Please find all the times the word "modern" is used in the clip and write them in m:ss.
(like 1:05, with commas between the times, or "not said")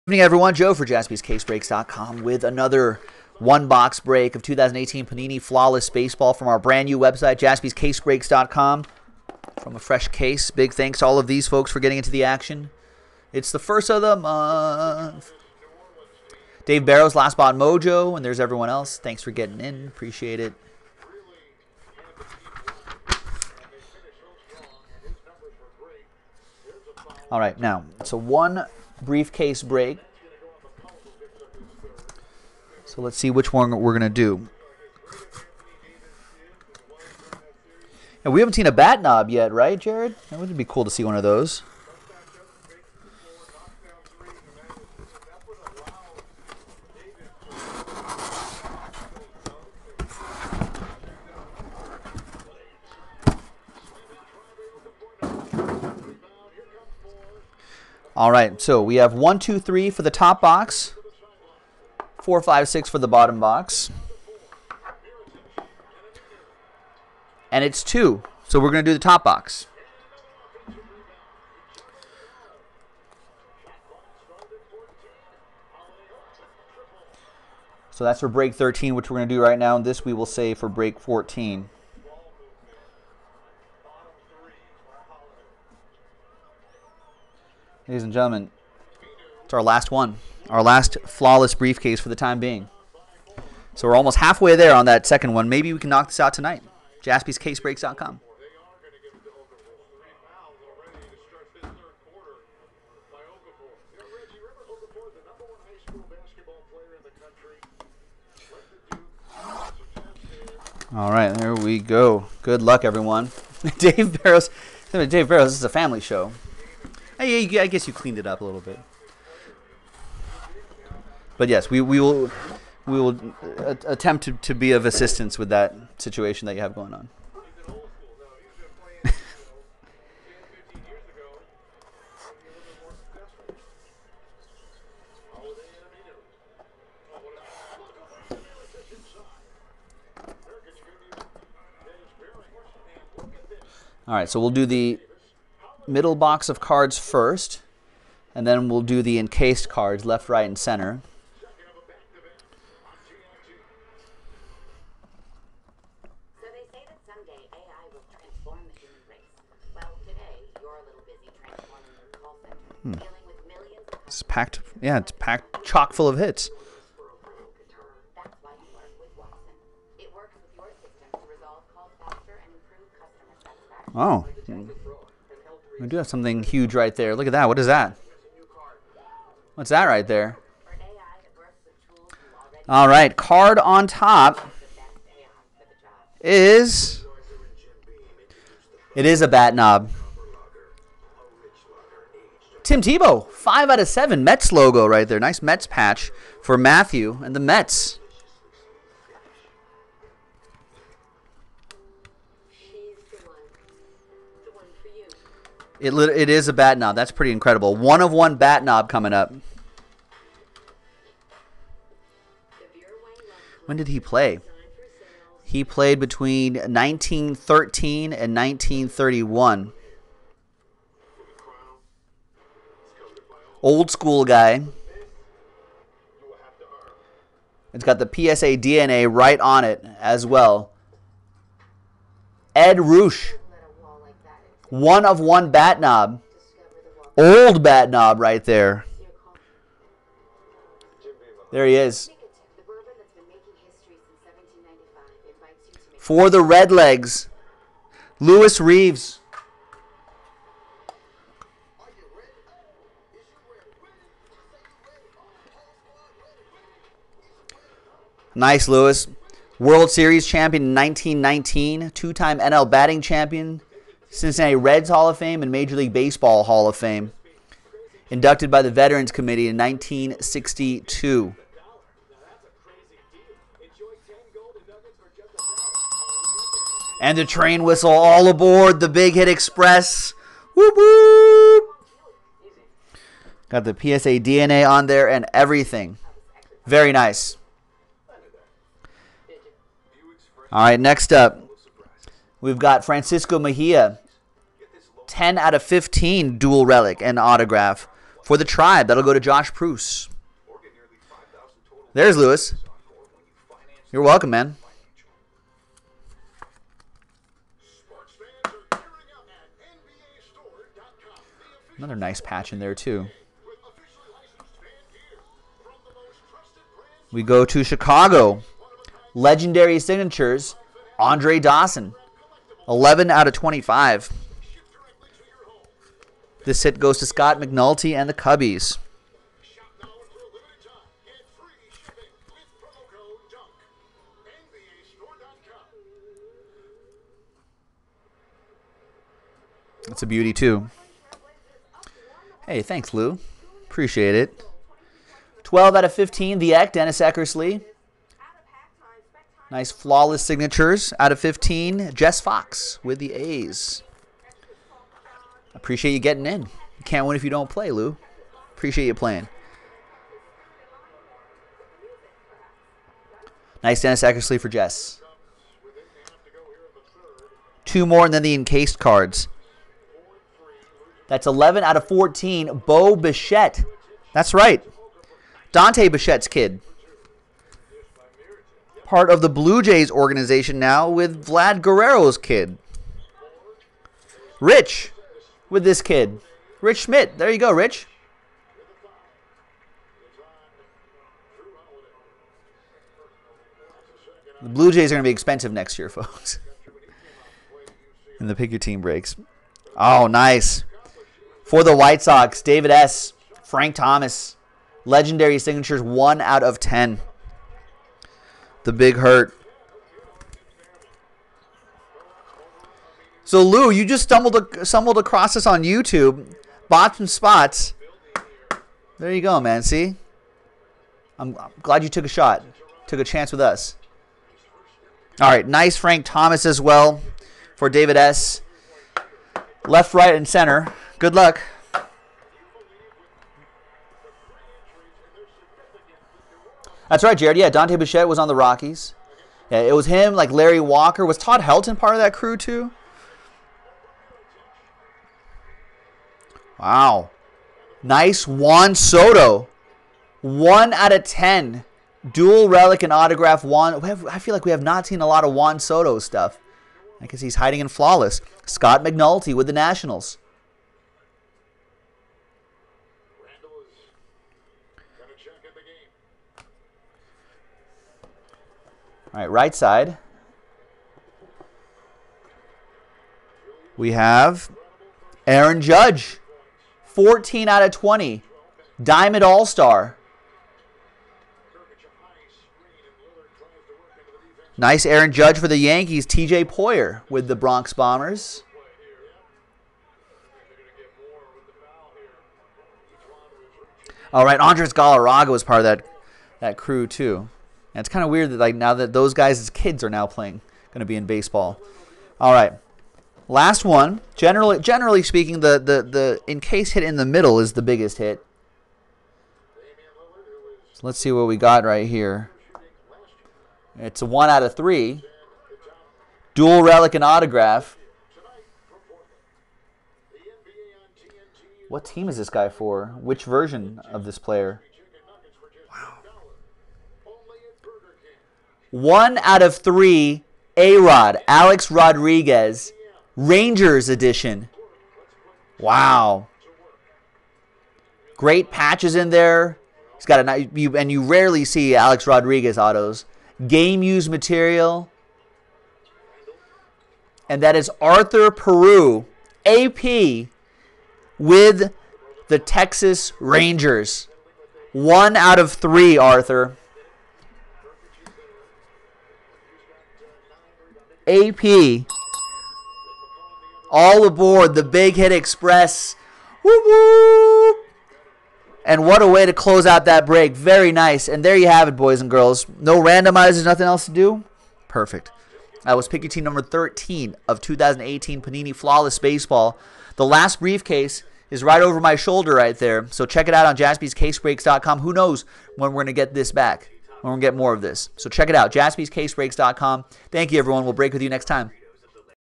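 not said.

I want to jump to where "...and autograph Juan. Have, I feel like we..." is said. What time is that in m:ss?
7:32.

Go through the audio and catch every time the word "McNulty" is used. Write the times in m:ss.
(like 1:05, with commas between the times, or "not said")
5:27, 7:38.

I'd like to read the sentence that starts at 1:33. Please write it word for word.
So we're almost halfway there on that second one.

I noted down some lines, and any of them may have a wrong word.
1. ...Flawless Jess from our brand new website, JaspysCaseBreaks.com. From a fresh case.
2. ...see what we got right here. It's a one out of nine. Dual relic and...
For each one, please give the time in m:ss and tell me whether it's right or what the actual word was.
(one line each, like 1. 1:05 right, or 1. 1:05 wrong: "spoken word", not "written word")
1. 0:05 wrong: "Baseball", not "Jess"
2. 8:30 wrong: "three", not "nine".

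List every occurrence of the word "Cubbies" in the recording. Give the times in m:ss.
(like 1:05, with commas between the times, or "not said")
5:28.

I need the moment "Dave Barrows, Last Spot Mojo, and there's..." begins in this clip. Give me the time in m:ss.
0:16.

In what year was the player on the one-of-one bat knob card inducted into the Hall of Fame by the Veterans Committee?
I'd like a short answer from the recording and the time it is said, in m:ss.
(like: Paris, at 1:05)
1962, at 4:29.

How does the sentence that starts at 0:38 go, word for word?
And we haven't seen a bat knob yet, right, Jared?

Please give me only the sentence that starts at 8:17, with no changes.
And it's kind of weird that like now that those guys as kids are now playing, going to be in baseball.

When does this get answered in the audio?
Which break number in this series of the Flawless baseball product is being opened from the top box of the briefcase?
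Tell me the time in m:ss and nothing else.
1:18.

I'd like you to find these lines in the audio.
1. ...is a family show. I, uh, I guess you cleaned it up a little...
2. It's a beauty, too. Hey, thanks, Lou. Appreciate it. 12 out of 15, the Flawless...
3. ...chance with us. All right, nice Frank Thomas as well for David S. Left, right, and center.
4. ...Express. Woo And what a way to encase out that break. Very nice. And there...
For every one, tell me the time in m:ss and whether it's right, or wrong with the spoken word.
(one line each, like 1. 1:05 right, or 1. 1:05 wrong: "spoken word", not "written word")
1. 1:55 right
2. 5:39 wrong: "Eck", not "Flawless"
3. 7:03 right
4. 9:25 wrong: "close", not "encase".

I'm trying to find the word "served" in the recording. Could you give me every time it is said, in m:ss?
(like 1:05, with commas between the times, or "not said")
not said.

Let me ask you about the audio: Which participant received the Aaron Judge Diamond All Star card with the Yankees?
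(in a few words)
TJ Poyer.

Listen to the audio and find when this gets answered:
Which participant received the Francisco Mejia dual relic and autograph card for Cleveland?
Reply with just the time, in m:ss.
4:59.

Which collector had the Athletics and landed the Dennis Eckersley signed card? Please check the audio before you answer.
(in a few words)
Jess Fox.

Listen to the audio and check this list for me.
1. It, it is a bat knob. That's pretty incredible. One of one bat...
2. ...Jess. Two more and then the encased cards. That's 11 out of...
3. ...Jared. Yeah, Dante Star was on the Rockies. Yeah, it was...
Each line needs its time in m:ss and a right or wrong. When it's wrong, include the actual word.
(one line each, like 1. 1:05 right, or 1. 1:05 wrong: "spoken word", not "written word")
1. 3:25 right
2. 6:04 right
3. 7:17 wrong: "Bichette", not "Star".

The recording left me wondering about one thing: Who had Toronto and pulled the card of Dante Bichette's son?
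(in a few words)
Rich Schmidt.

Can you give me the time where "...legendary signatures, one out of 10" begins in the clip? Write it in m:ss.
6:44.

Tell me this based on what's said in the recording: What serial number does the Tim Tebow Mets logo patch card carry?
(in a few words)
5/7.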